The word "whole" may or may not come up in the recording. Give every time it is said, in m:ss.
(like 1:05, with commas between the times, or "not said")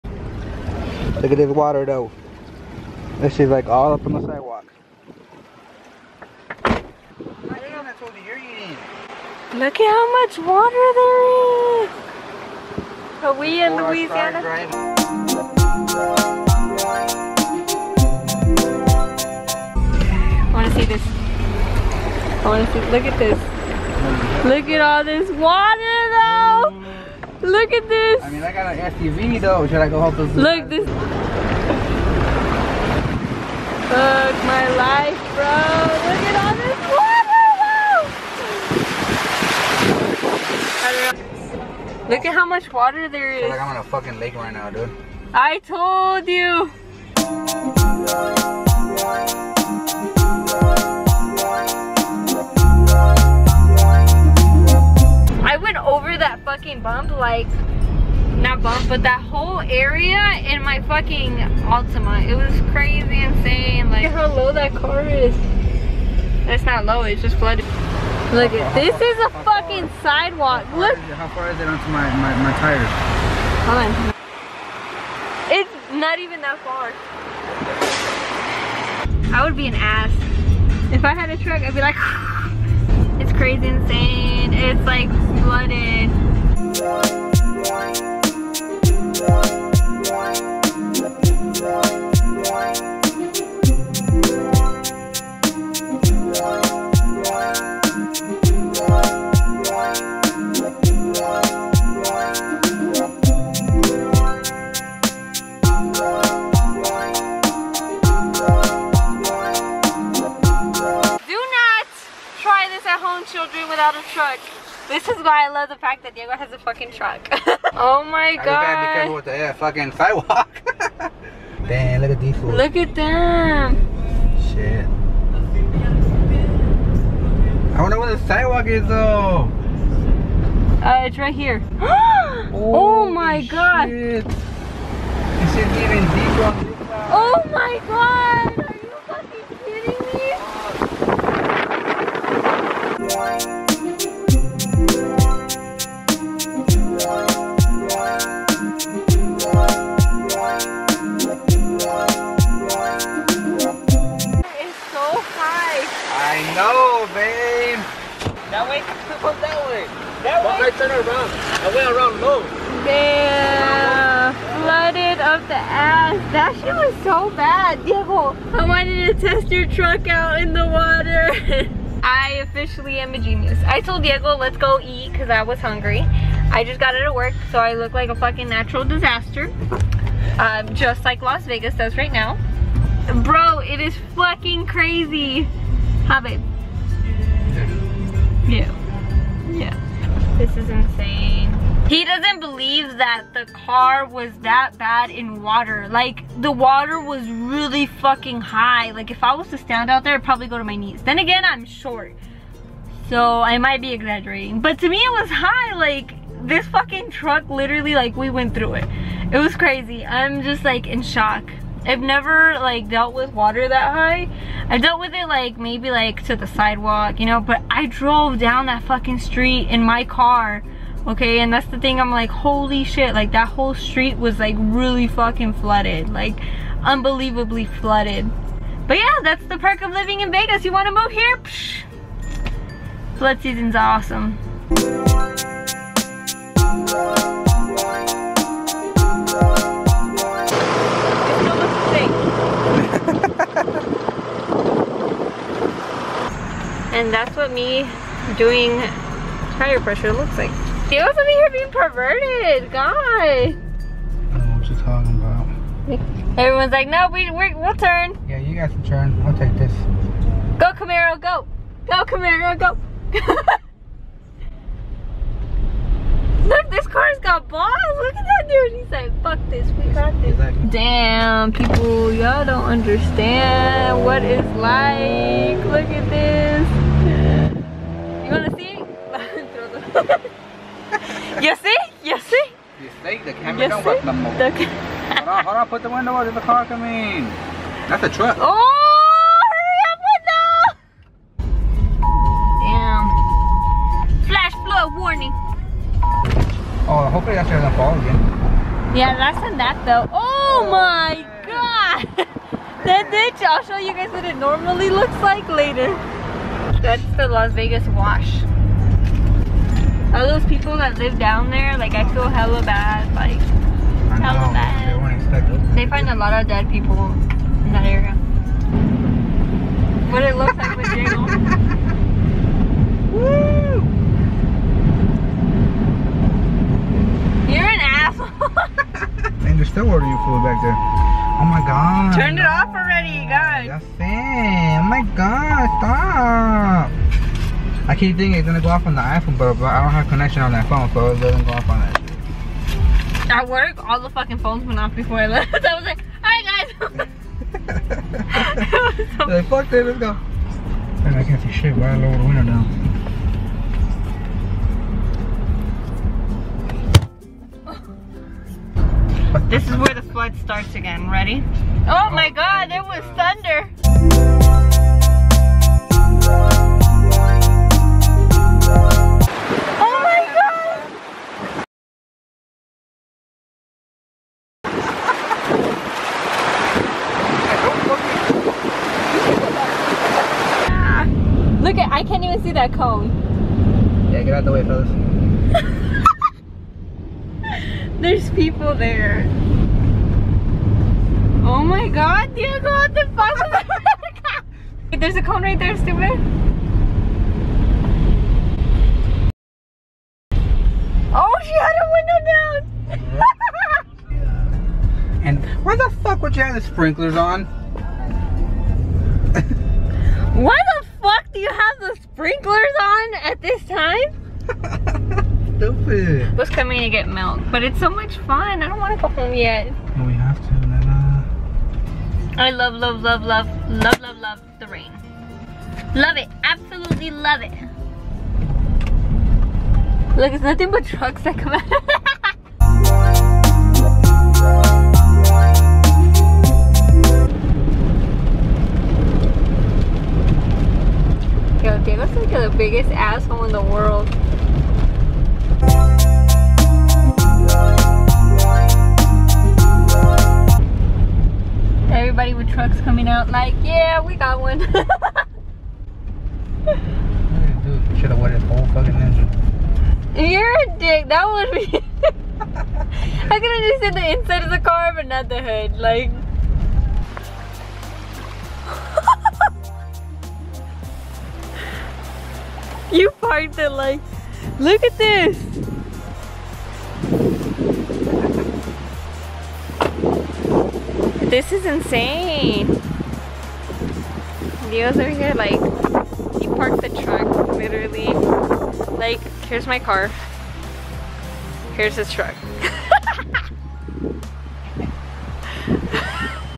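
0:59, 3:43, 7:38.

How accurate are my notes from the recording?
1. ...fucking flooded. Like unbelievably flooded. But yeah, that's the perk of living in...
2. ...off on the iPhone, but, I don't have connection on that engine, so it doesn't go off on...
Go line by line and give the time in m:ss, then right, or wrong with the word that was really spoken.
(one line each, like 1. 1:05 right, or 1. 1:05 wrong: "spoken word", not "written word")
1. 3:45 right
2. 5:38 wrong: "phone", not "engine".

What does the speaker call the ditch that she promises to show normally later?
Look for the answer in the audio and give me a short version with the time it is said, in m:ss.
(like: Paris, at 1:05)
Las Vegas wash, at 5:07.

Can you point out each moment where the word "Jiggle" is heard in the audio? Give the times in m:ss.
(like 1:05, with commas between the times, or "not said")
5:20.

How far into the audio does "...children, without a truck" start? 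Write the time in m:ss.
1:53.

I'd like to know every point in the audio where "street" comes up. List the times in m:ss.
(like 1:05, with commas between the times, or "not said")
3:39, 3:43.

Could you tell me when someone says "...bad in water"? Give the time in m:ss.
3:14.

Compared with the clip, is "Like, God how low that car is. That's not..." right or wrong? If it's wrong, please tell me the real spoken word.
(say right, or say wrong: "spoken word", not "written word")
wrong: "Look", not "God".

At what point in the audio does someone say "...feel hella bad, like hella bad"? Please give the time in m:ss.
5:12.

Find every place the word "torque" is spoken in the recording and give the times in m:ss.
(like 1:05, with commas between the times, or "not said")
not said.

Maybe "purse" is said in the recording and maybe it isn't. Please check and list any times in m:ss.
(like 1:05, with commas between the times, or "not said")
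not said.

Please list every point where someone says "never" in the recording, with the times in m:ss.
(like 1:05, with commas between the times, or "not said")
3:32.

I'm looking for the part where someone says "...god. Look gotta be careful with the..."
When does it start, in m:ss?
1:58.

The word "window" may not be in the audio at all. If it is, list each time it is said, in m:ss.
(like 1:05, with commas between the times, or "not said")
4:45, 5:52, 6:41.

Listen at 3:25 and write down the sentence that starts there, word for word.
Like, this fucking truck literally, like, we went through it.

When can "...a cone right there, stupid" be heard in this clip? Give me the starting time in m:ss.
6:35.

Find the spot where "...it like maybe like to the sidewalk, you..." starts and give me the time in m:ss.
3:35.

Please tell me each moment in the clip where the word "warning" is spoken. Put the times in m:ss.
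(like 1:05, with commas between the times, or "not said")
4:54.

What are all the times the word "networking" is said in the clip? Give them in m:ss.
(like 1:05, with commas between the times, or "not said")
not said.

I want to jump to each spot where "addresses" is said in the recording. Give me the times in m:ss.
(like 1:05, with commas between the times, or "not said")
not said.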